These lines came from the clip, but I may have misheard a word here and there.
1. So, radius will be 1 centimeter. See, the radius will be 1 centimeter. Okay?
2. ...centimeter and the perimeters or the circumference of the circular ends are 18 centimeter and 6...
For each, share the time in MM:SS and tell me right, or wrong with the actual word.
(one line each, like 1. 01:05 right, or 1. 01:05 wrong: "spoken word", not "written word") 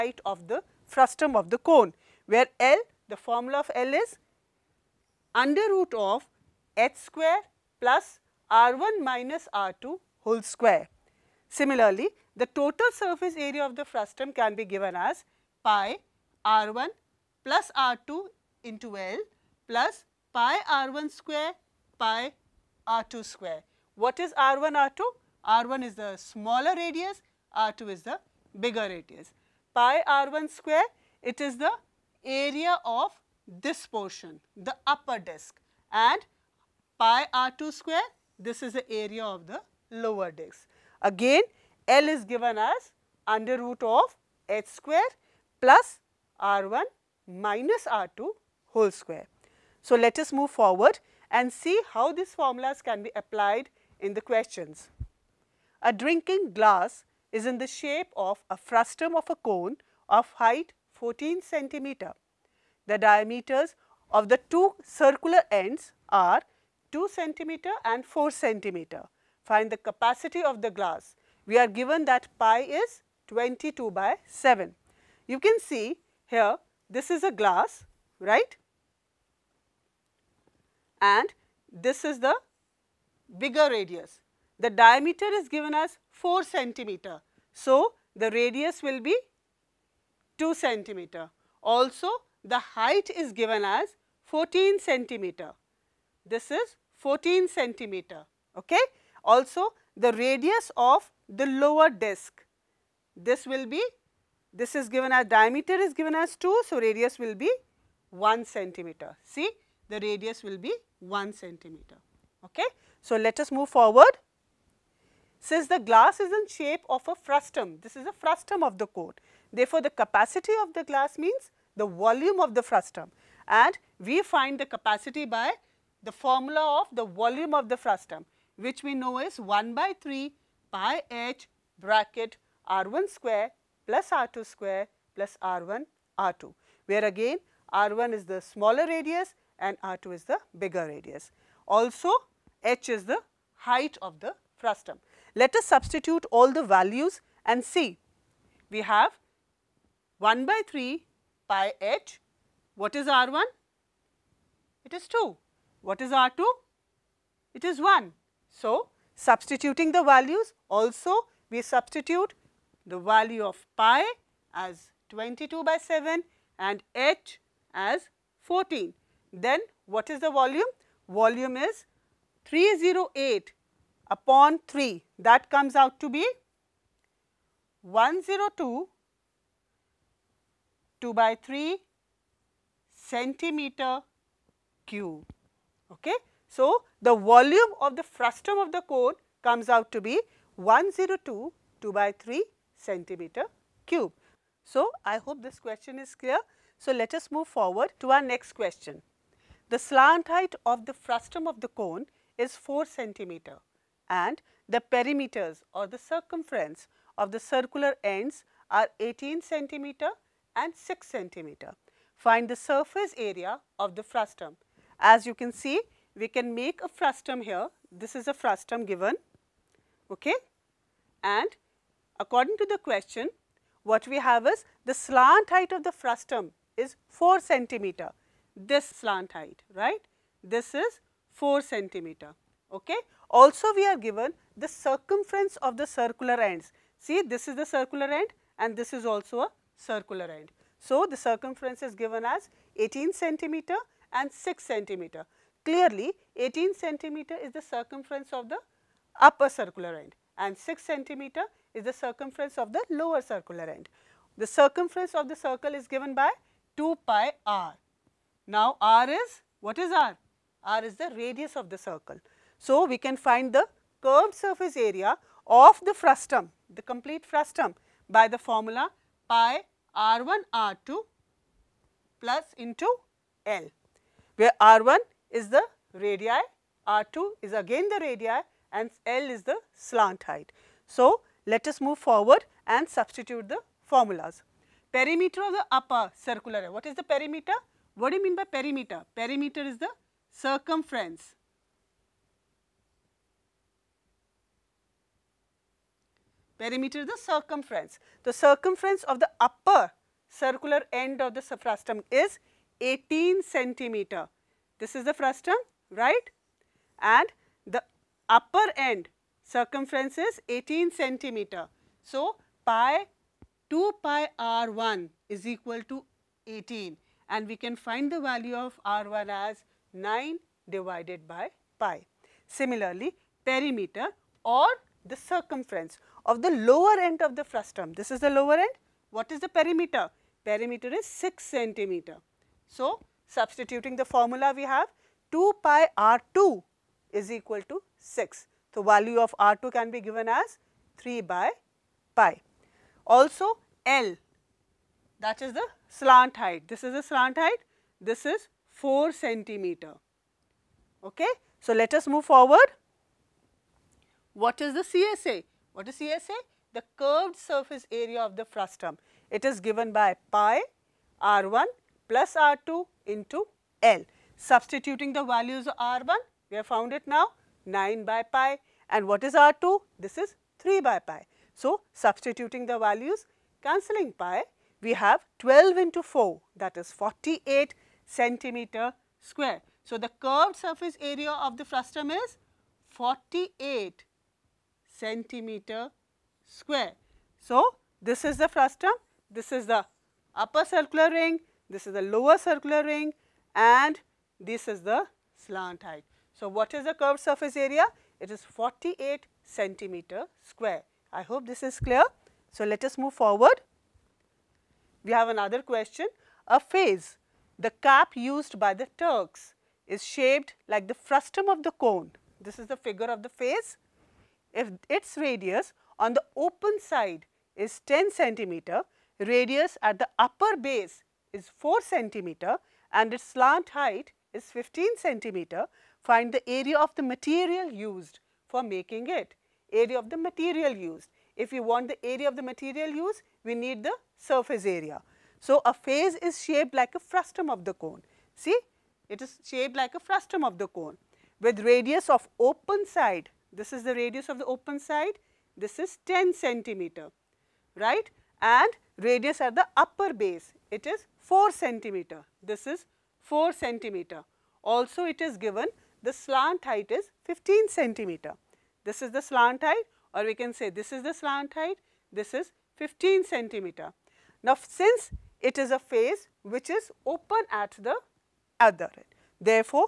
1. 01:46 right
2. 03:22 right.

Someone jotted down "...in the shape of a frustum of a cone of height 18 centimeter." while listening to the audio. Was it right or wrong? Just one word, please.
wrong.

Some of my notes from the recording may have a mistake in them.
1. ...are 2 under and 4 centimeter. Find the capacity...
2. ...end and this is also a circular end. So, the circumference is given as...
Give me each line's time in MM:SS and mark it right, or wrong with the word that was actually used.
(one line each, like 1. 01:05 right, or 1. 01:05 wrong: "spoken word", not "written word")
1. 01:06 wrong: "centimeter", not "under"
2. 03:58 right.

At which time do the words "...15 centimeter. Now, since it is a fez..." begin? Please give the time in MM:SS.
07:42.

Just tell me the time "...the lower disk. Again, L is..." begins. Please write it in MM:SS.
00:39.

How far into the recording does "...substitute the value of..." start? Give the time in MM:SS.
02:41.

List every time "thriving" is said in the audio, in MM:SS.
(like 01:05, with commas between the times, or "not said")
not said.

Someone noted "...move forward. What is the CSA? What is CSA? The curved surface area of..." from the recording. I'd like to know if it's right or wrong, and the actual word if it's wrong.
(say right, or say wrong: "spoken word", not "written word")
right.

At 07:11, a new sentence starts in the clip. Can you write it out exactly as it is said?
If we want the area of the material used, we need the surface area.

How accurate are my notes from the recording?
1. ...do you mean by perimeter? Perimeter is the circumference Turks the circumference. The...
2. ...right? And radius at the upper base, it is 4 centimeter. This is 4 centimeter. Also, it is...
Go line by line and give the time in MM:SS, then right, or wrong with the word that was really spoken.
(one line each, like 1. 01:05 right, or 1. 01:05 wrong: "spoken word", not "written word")
1. 04:48 wrong: "Perimeter", not "Turks"
2. 07:27 right.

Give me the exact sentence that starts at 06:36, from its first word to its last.
So, what is the curved surface area?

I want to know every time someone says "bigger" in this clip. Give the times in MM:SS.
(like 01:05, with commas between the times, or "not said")
00:28, 01:23, 02:20.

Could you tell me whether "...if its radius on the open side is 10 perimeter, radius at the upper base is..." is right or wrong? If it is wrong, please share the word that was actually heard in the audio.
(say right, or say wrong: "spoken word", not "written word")
wrong: "centimeter", not "perimeter".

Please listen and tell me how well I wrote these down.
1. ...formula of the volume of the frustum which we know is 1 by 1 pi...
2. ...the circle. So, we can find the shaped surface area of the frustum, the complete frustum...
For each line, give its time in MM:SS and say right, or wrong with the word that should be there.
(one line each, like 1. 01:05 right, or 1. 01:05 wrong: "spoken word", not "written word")
1. 02:06 wrong: "3", not "1"
2. 04:21 wrong: "curved", not "shaped".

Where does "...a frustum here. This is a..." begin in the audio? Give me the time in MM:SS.
03:36.